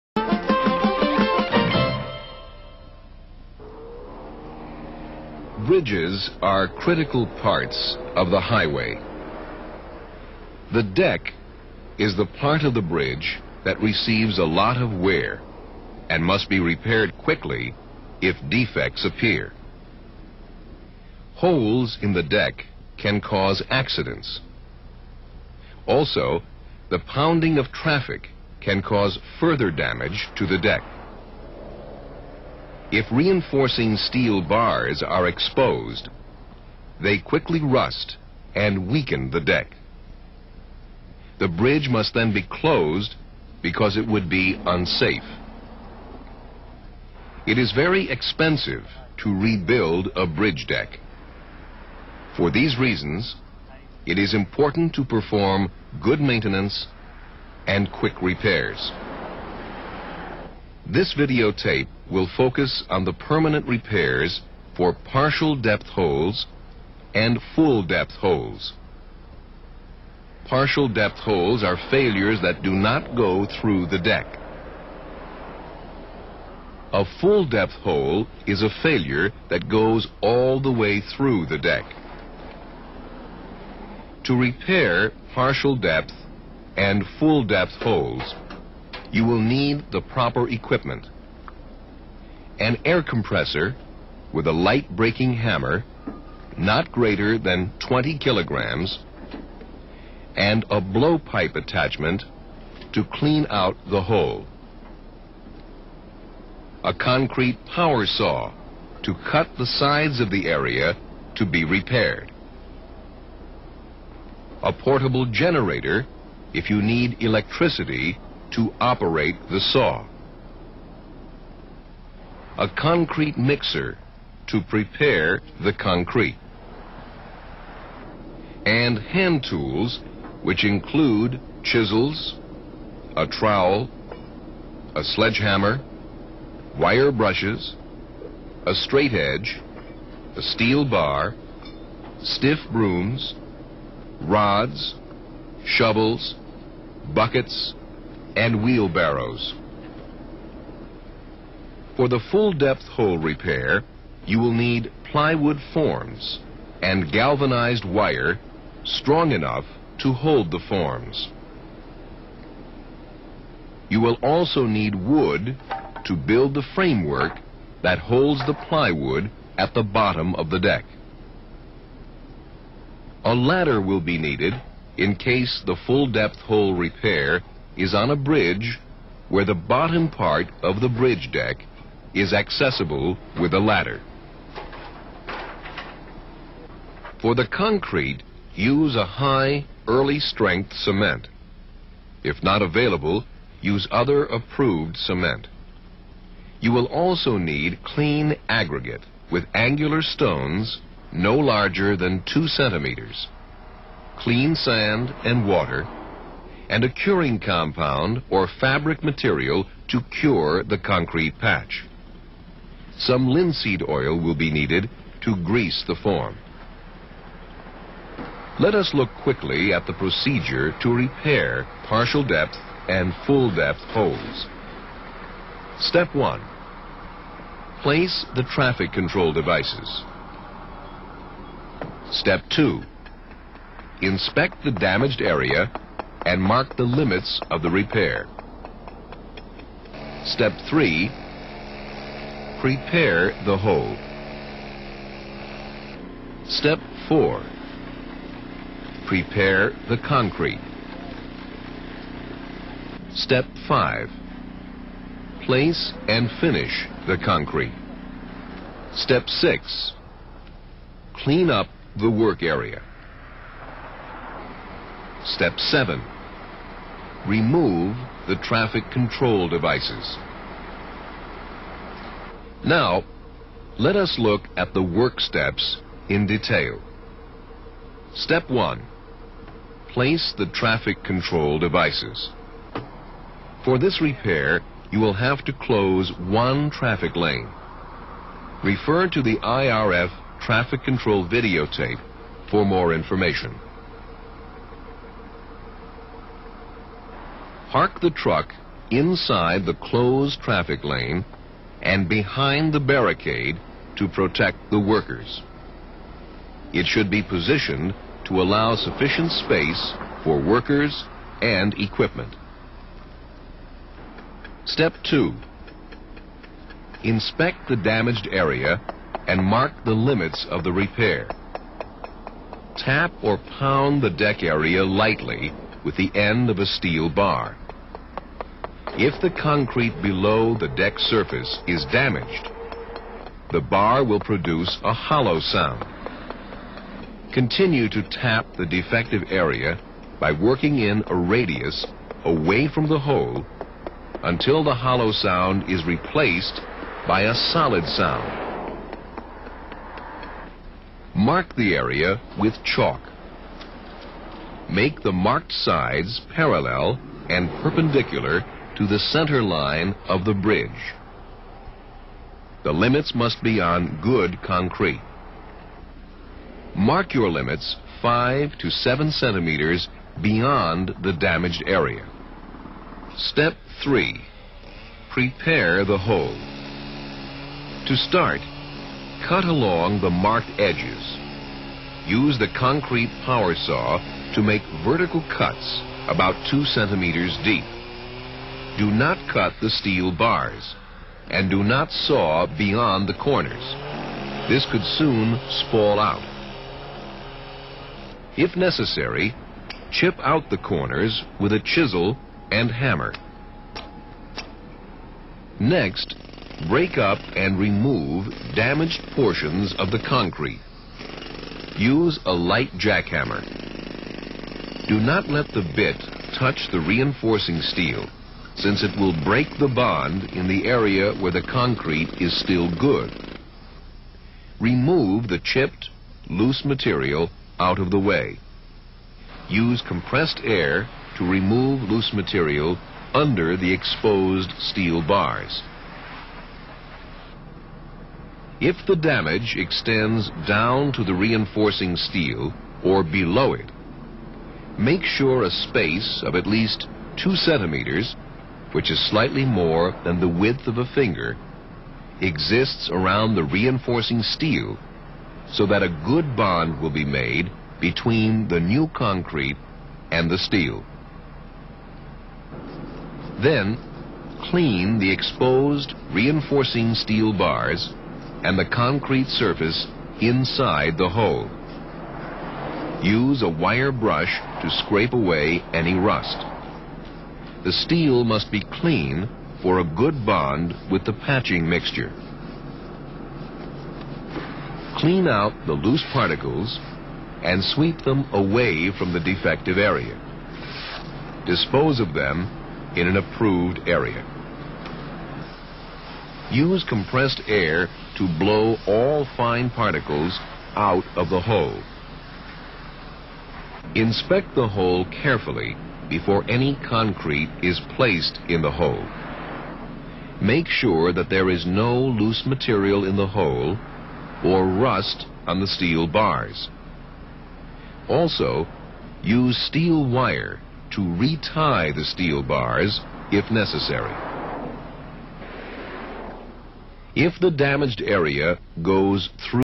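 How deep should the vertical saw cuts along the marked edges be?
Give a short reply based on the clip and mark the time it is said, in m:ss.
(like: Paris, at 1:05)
About 2 centimeters, at 6:26.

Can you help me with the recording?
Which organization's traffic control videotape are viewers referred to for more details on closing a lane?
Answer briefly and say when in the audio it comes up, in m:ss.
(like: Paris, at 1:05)
IRF, at 4:49.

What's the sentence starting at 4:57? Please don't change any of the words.
park the truck inside the closed traffic lane and behind the barricade to protect the workers.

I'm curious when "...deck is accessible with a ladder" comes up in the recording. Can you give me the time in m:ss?
3:01.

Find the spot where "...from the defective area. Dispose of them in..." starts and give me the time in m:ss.
8:08.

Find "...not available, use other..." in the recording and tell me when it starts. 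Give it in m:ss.
3:12.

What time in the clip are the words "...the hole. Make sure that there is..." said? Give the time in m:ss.
8:28.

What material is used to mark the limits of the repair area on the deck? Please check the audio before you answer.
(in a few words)
Chalk.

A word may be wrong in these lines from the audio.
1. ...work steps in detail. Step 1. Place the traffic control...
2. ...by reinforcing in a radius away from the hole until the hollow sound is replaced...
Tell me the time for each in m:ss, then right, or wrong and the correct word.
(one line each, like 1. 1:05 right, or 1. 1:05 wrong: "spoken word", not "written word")
1. 4:34 right
2. 5:40 wrong: "working", not "reinforcing".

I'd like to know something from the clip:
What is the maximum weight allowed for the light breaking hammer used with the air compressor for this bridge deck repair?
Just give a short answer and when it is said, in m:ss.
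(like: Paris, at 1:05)
20 kilograms, at 1:37.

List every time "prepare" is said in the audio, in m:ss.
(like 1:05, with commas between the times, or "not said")
2:04, 4:02, 4:09, 6:15.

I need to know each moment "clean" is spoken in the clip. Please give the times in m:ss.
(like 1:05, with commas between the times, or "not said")
1:43, 3:17, 3:24, 4:21, 7:44, 7:58, 8:04.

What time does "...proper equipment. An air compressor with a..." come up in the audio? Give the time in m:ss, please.
1:30.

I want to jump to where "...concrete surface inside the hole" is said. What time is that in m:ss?
7:48.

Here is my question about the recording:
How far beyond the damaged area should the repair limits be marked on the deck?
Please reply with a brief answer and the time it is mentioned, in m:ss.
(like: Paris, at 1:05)
5 to 7 centimeters, at 6:08.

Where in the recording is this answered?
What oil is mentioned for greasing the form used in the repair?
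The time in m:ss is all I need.
3:33.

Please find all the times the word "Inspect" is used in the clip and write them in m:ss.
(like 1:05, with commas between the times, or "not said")
3:54, 5:17, 8:23.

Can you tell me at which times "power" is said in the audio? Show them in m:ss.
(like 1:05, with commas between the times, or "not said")
1:47, 6:23.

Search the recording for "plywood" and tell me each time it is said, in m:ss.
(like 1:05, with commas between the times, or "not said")
2:35, 2:48.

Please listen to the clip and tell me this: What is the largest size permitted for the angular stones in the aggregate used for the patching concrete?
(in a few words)
2 centimeters.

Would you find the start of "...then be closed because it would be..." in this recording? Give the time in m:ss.
0:42.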